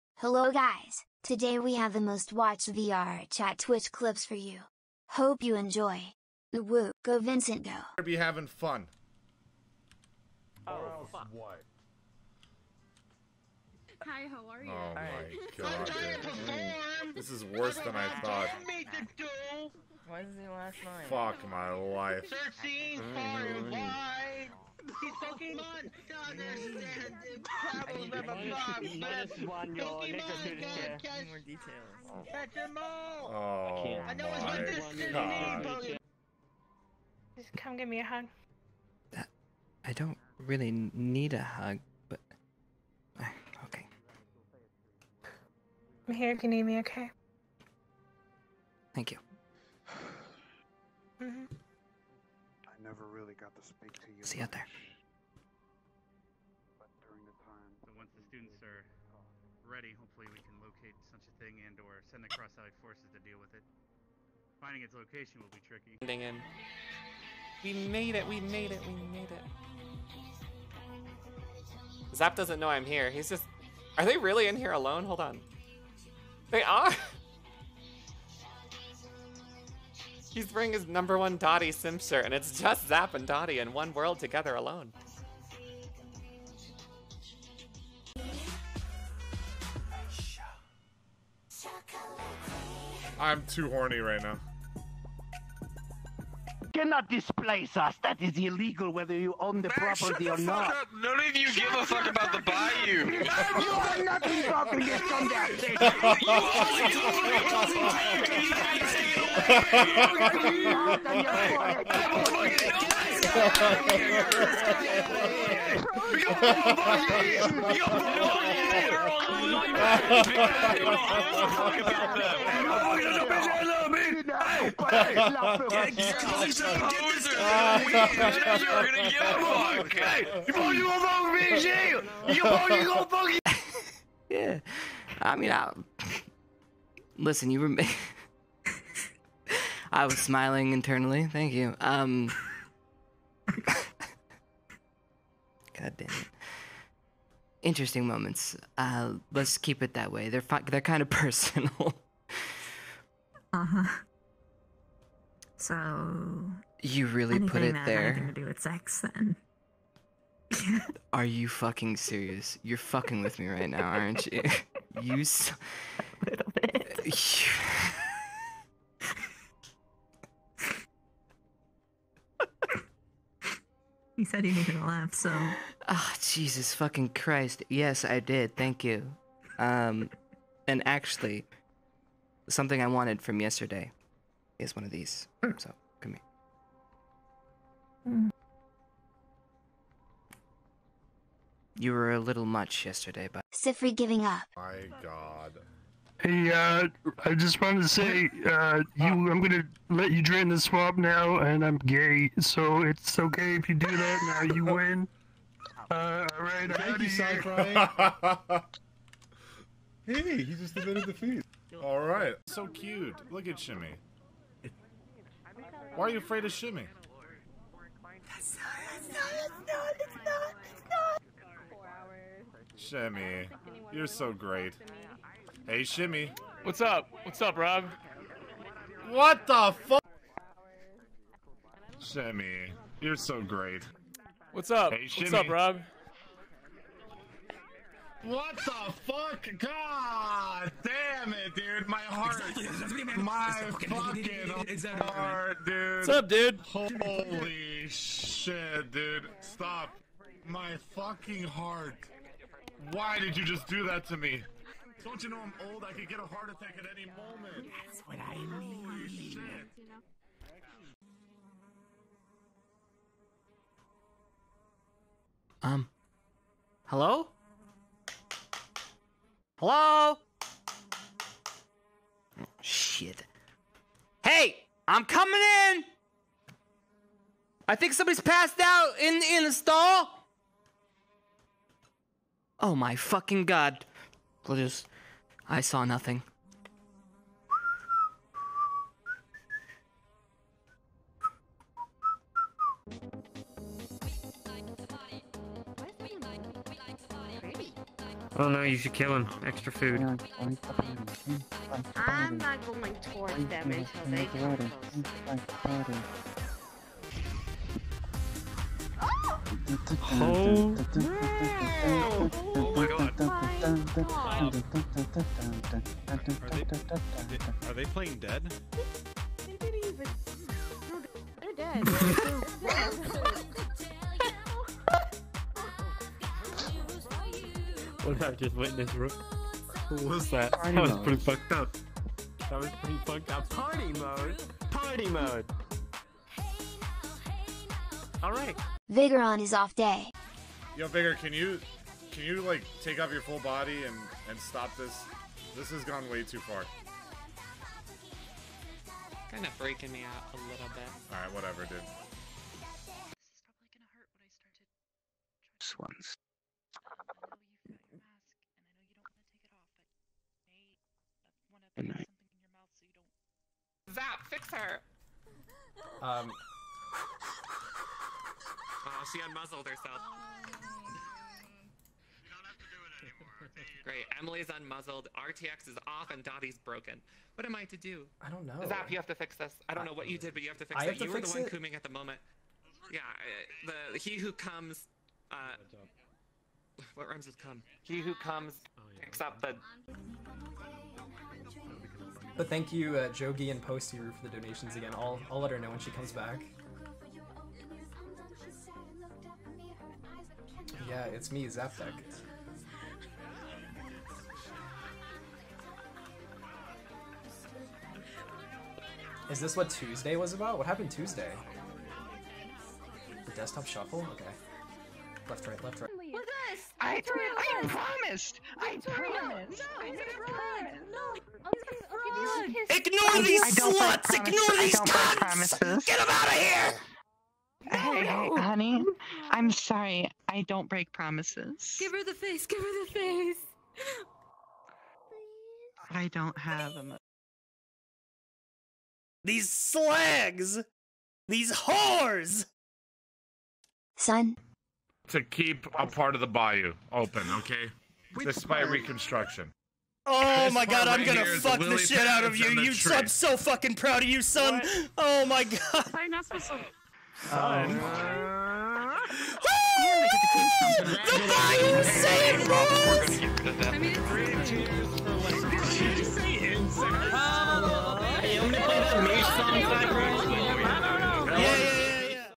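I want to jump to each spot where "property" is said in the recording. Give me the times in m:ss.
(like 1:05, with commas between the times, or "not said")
1:39.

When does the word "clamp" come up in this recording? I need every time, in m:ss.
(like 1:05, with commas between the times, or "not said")
not said.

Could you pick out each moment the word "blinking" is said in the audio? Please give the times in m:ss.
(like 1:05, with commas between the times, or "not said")
not said.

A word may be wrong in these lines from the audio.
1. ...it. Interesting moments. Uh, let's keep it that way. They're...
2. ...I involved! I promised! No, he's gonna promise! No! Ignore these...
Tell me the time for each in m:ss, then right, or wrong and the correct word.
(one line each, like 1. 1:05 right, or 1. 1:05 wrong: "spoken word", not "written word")
1. 2:26 right
2. 6:57 wrong: "promised", not "involved".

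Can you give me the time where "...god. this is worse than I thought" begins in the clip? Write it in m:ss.
0:15.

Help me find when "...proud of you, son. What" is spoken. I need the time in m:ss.
7:33.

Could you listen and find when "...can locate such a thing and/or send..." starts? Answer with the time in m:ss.
1:00.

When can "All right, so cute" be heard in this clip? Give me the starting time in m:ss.
3:31.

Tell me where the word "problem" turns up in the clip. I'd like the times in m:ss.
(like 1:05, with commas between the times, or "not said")
0:27.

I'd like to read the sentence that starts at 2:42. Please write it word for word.
You're fucking with me right now, aren't you?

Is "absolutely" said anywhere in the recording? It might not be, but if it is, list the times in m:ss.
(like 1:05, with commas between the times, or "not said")
not said.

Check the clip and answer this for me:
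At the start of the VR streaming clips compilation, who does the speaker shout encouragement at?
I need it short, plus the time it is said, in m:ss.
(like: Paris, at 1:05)
Vincent, at 0:07.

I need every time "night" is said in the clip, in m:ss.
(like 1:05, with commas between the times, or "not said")
0:20, 6:01.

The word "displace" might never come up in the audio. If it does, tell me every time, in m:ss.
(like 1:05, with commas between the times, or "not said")
1:37.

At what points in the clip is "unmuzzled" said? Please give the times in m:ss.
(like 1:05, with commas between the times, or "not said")
6:09, 6:14.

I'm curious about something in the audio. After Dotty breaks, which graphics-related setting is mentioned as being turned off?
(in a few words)
RTX.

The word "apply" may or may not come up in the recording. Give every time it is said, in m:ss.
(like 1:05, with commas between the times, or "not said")
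not said.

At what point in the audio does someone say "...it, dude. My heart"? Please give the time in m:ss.
4:01.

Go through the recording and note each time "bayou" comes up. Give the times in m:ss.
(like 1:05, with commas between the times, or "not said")
1:42, 7:26.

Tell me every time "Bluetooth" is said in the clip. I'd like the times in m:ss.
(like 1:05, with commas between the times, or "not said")
not said.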